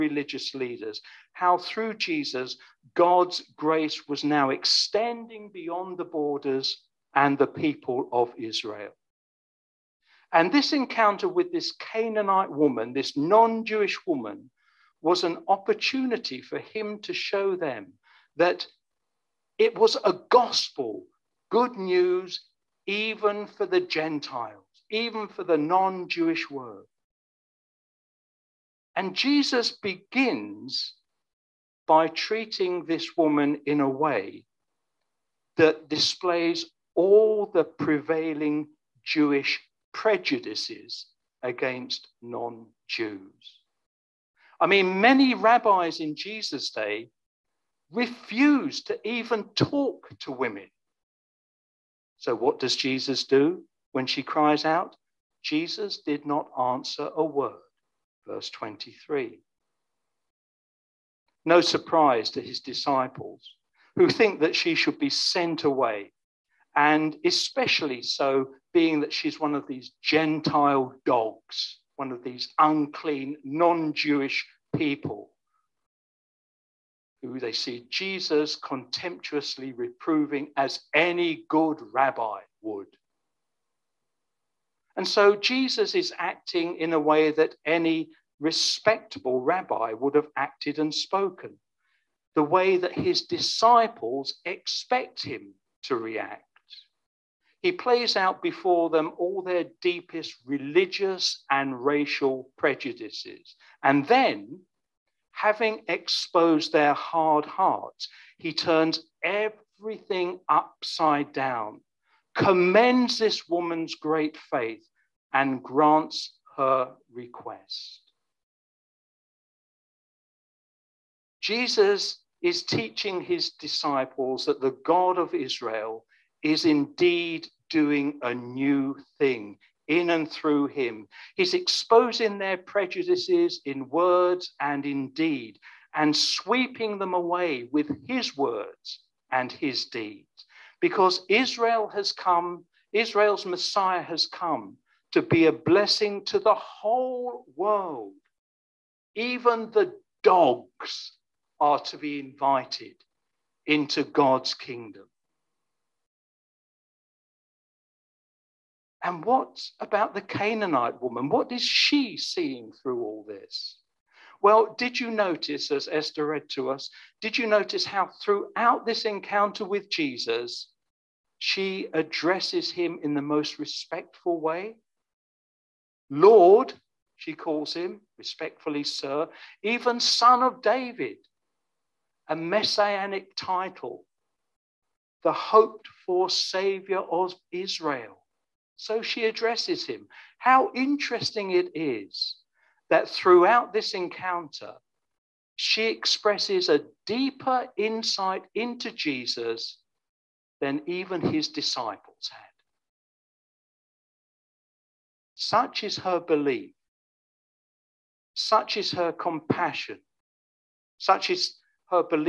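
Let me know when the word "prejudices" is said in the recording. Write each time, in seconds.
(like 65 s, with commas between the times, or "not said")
39 s, 102 s, 132 s.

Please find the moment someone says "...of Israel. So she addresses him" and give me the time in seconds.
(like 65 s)
187 s.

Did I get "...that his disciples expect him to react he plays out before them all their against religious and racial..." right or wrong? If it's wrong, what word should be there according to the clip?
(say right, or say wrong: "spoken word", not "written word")
wrong: "deepest", not "against".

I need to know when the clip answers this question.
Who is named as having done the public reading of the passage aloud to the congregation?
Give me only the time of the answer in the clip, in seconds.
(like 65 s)
165 s.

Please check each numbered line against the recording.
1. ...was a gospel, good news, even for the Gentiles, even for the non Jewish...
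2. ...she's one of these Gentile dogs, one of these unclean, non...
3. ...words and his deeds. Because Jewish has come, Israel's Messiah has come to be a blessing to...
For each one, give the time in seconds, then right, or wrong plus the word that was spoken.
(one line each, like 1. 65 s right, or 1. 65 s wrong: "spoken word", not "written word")
1. 19 s right
2. 69 s right
3. 138 s wrong: "Israel", not "Jewish".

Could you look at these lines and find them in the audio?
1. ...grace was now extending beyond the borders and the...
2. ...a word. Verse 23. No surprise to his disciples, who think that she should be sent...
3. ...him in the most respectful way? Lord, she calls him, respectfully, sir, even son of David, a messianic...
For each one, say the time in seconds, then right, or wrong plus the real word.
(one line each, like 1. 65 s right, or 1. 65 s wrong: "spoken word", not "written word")
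1. 3 s right
2. 57 s right
3. 172 s right.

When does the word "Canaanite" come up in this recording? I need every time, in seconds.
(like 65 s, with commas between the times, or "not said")
11 s, 160 s.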